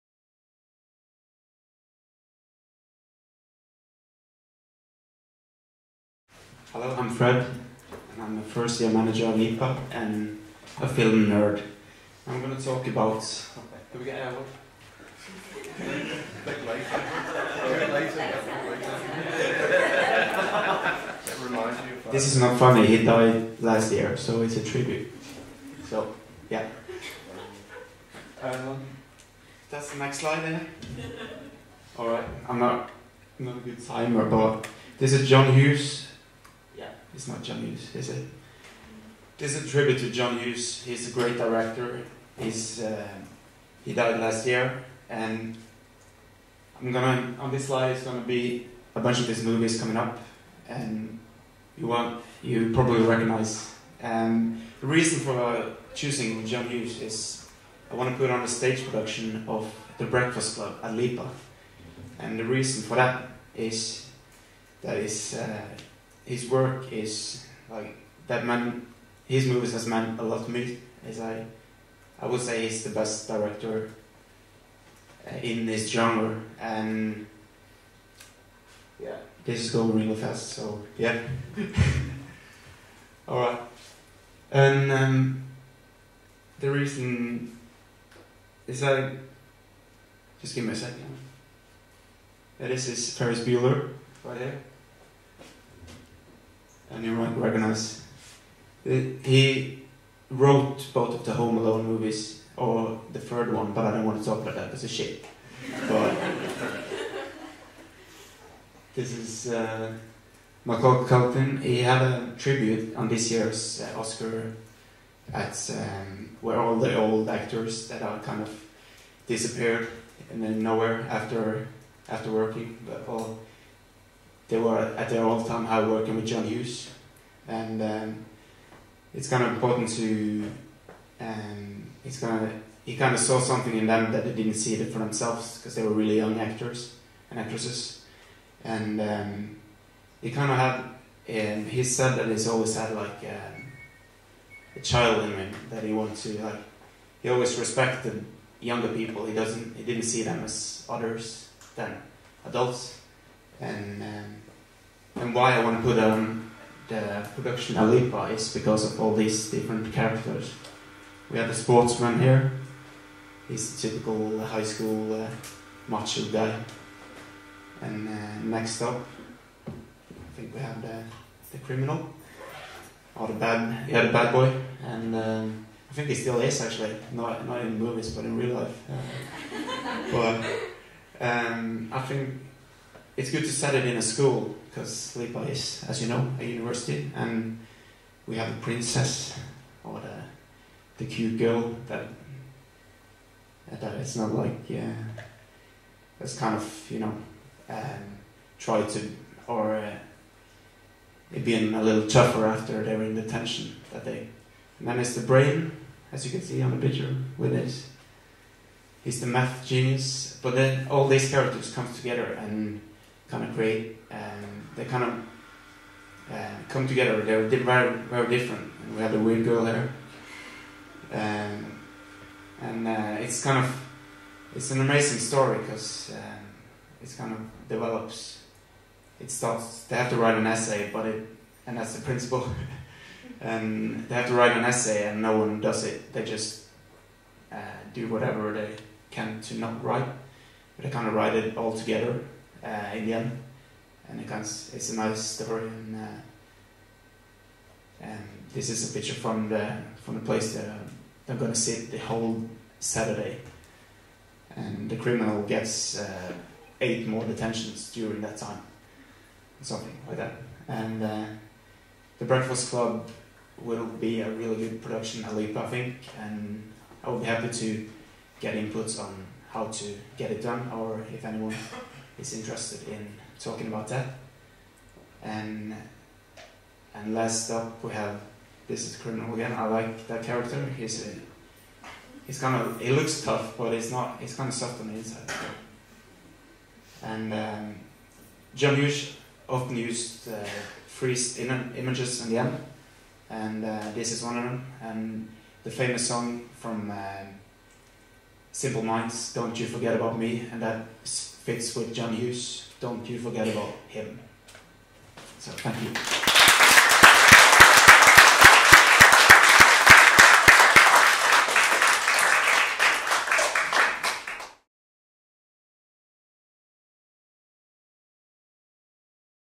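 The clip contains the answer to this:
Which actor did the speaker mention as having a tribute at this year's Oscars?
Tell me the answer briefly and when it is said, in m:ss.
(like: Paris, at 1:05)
Macaulay Culkin, at 1:50.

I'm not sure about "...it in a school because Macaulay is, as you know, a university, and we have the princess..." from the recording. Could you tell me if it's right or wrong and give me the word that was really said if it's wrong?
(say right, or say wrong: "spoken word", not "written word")
wrong: "LIPA", not "Macaulay".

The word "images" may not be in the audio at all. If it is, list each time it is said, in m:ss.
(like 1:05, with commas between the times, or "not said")
4:51.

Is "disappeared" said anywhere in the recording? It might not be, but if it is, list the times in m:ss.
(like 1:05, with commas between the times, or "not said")
1:59.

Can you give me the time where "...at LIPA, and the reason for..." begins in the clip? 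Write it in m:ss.
1:00.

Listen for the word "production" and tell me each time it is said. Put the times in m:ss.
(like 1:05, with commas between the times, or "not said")
0:58, 2:37, 4:24.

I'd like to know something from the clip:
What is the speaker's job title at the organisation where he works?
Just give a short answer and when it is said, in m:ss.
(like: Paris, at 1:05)
First year manager, at 0:08.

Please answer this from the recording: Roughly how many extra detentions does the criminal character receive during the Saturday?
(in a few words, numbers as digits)
8.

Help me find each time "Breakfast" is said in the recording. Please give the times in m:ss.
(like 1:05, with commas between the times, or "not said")
1:00, 4:22.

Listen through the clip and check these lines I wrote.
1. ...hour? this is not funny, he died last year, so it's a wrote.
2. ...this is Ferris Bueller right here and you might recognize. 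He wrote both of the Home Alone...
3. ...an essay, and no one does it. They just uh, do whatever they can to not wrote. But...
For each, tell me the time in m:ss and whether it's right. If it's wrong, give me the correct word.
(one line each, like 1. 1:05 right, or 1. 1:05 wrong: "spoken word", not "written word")
1. 0:14 wrong: "tribute", not "wrote"
2. 1:32 right
3. 3:54 wrong: "write", not "wrote".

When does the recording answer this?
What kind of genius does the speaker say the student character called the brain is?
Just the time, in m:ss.
3:29.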